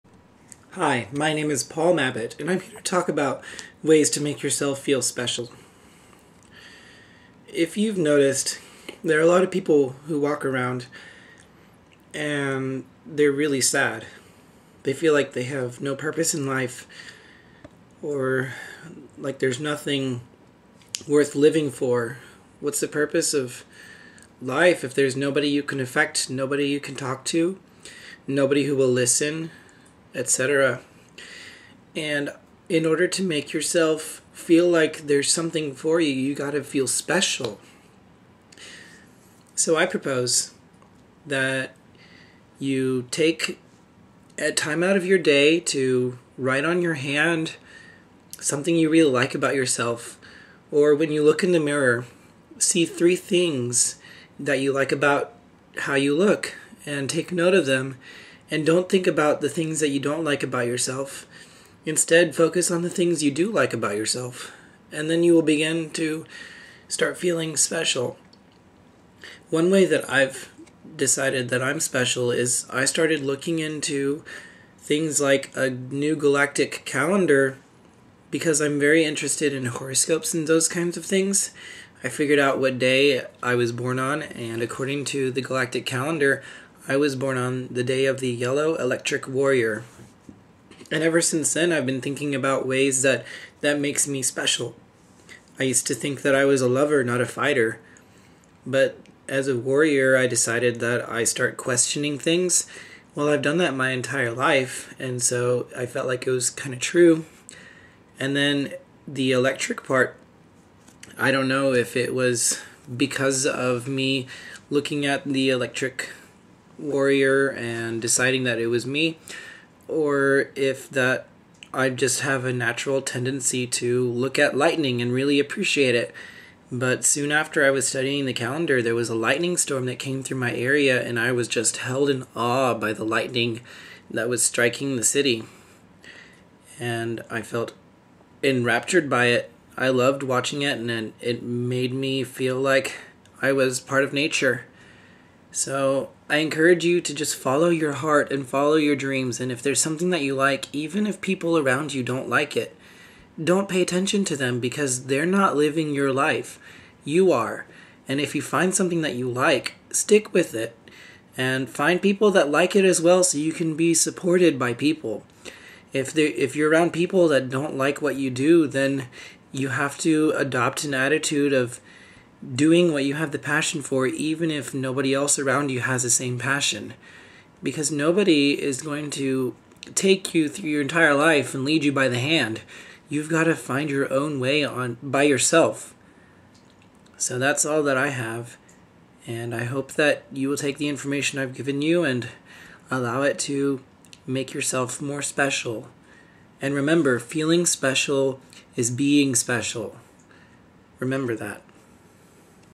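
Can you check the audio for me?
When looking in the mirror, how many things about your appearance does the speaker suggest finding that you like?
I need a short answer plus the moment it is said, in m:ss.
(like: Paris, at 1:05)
3, at 0:52.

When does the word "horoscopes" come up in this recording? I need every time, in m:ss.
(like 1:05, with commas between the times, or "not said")
1:19.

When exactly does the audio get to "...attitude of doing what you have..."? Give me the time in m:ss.
2:50.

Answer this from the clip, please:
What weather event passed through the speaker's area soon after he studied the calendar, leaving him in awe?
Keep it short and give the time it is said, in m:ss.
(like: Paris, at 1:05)
lightning storm, at 2:09.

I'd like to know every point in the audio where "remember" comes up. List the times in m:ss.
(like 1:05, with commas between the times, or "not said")
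3:16, 3:20.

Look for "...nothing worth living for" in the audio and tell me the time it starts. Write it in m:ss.
0:19.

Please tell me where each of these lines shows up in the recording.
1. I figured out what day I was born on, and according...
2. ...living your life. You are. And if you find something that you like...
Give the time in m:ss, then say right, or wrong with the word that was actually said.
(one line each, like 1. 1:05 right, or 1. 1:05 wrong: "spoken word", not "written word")
1. 1:22 right
2. 2:35 right.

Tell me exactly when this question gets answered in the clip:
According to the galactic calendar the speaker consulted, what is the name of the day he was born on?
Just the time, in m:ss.
1:28.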